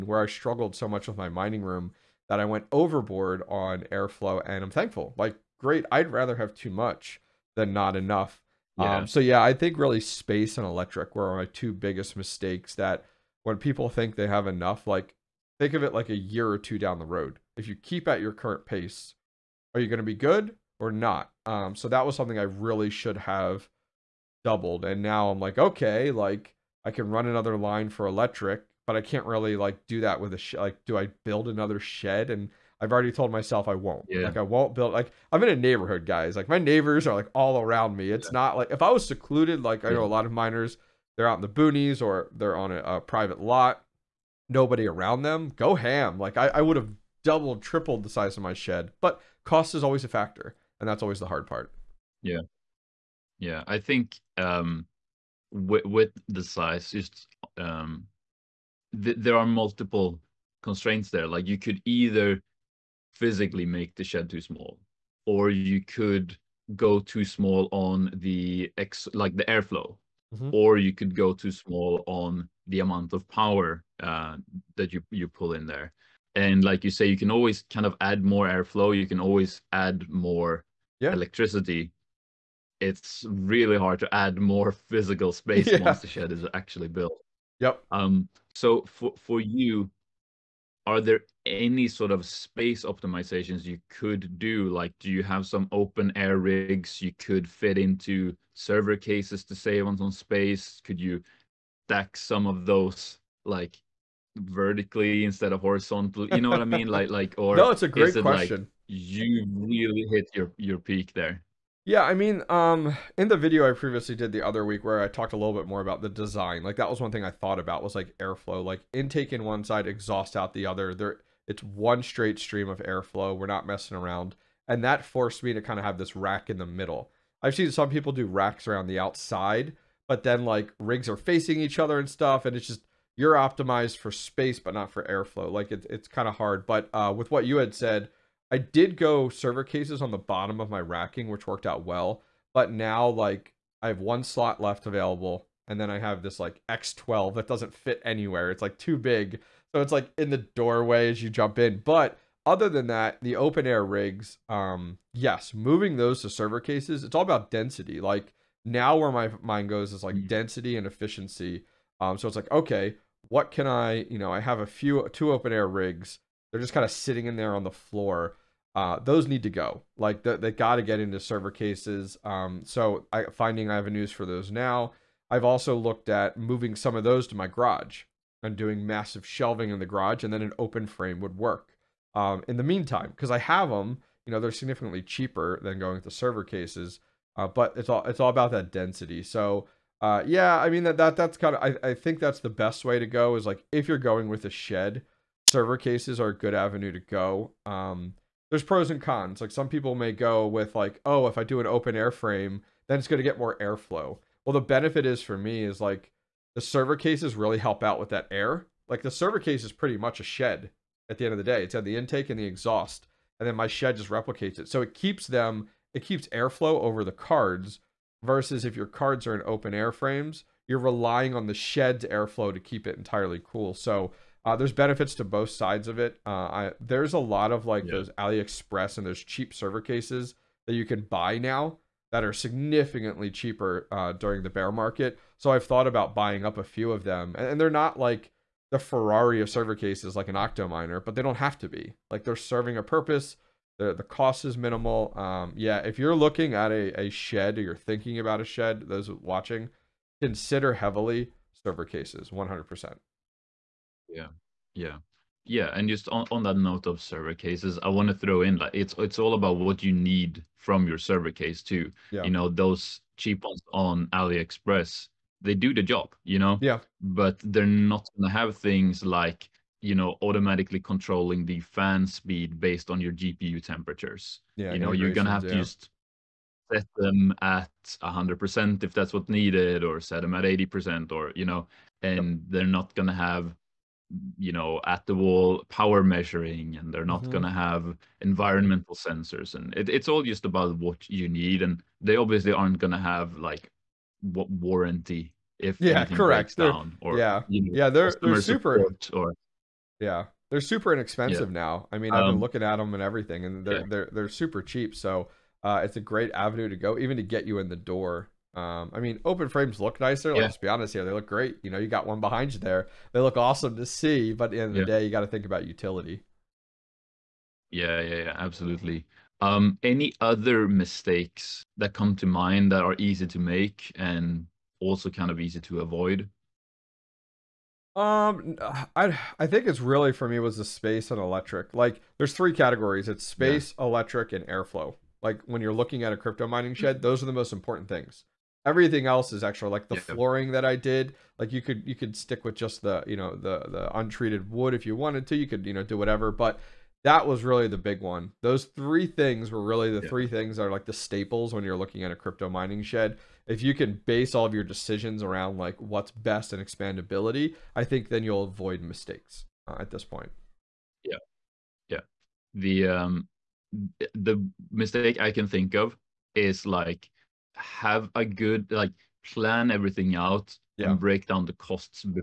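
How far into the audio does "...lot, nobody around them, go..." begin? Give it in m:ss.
0:43.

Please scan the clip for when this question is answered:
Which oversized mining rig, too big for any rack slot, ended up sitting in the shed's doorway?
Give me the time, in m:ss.
2:26.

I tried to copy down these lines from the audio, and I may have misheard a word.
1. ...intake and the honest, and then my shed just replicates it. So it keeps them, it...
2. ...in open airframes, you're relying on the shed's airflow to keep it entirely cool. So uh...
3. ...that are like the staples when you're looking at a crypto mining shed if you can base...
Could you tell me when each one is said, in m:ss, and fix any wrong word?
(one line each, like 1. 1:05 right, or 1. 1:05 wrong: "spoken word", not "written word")
1. 3:31 wrong: "exhaust", not "honest"
2. 3:39 right
3. 5:50 right.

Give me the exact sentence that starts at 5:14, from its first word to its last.
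the day, you got to think about utility.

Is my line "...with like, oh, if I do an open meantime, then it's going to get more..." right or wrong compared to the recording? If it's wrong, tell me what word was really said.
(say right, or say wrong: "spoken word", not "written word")
wrong: "airframe", not "meantime".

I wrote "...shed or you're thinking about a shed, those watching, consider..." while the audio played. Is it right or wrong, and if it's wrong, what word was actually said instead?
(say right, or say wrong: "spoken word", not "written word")
right.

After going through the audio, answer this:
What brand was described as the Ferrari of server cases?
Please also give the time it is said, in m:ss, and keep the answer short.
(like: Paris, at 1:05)
Octominer, at 4:00.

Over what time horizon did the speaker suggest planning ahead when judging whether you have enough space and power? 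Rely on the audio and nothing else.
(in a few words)
a year or two.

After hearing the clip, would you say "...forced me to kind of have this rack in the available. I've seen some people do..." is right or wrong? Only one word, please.
wrong.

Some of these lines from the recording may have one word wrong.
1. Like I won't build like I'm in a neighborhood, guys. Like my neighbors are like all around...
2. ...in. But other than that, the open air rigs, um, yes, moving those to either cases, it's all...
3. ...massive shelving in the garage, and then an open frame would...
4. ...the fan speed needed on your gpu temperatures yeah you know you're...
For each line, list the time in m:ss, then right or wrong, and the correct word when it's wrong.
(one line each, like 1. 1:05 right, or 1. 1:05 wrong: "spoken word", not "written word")
1. 0:34 right
2. 2:31 wrong: "server", not "either"
3. 2:58 right
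4. 4:31 wrong: "based", not "needed".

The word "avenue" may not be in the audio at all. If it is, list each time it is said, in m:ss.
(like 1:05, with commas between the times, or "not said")
2:53, 3:16, 5:06.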